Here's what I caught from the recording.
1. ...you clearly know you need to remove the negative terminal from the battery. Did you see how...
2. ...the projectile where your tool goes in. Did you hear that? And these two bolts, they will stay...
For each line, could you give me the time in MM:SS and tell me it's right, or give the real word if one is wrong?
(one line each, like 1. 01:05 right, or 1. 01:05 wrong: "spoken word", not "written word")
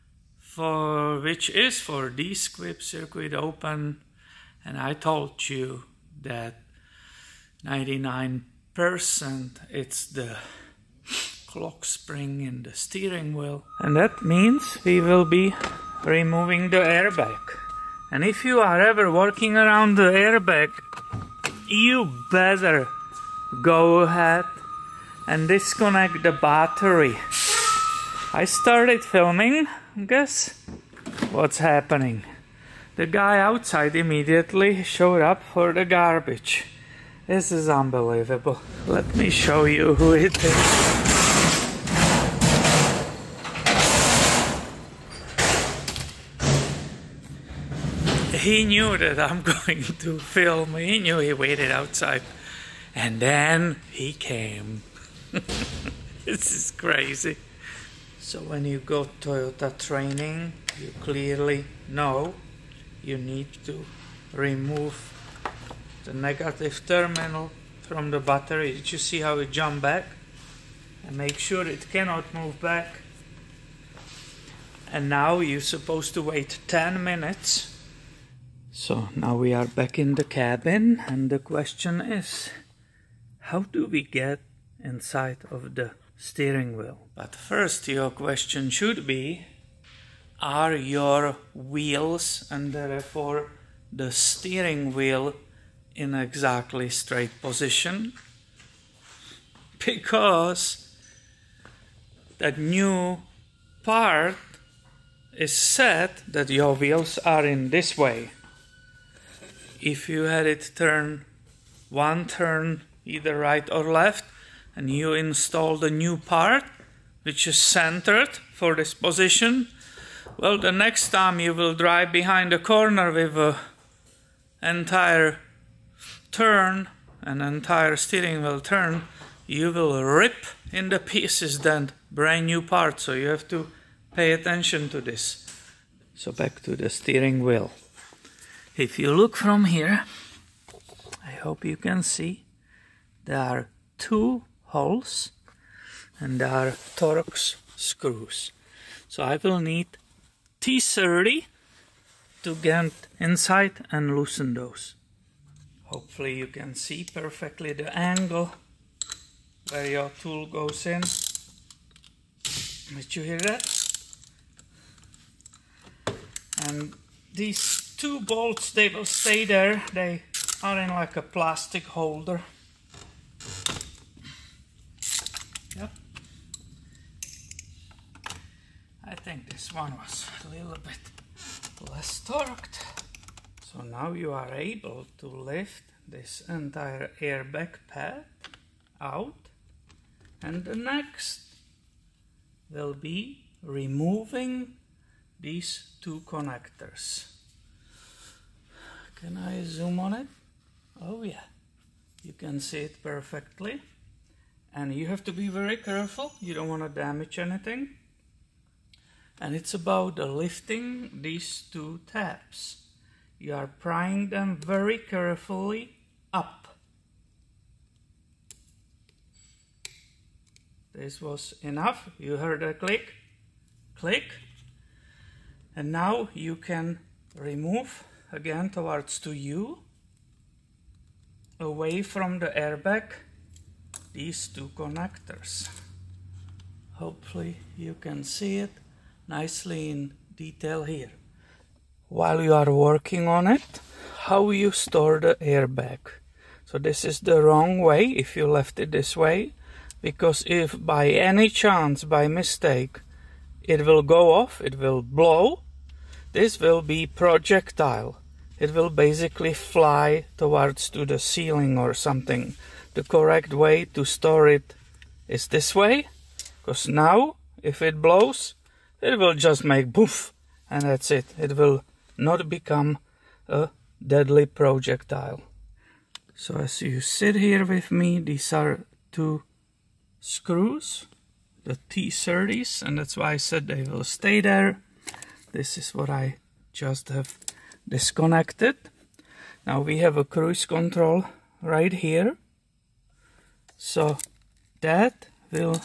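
1. 01:00 right
2. 02:37 wrong: "angle", not "projectile".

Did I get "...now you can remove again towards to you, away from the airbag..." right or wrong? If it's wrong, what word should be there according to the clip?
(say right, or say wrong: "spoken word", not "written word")
right.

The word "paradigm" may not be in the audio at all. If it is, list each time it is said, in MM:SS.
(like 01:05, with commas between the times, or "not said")
not said.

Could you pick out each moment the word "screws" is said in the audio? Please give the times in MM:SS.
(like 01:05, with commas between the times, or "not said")
02:27, 04:40.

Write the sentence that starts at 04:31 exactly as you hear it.
It will not become a deadly projectile.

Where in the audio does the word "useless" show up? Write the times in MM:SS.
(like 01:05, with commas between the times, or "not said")
not said.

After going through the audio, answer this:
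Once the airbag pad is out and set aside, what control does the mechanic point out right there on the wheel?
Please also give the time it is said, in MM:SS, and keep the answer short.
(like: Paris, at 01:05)
cruise control, at 04:50.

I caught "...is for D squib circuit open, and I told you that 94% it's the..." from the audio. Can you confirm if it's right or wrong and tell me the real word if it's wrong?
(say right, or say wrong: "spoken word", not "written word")
wrong: "99", not "94".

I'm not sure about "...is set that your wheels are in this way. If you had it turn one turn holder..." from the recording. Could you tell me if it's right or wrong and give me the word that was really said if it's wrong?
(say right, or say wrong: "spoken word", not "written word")
wrong: "either", not "holder".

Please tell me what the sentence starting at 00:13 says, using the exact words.
And that means we will be removing the airbag.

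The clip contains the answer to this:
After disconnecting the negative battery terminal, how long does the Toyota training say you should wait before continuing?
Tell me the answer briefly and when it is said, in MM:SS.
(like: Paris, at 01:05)
10 minutes, at 01:16.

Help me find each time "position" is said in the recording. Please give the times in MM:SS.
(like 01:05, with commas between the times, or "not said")
01:37, 01:58.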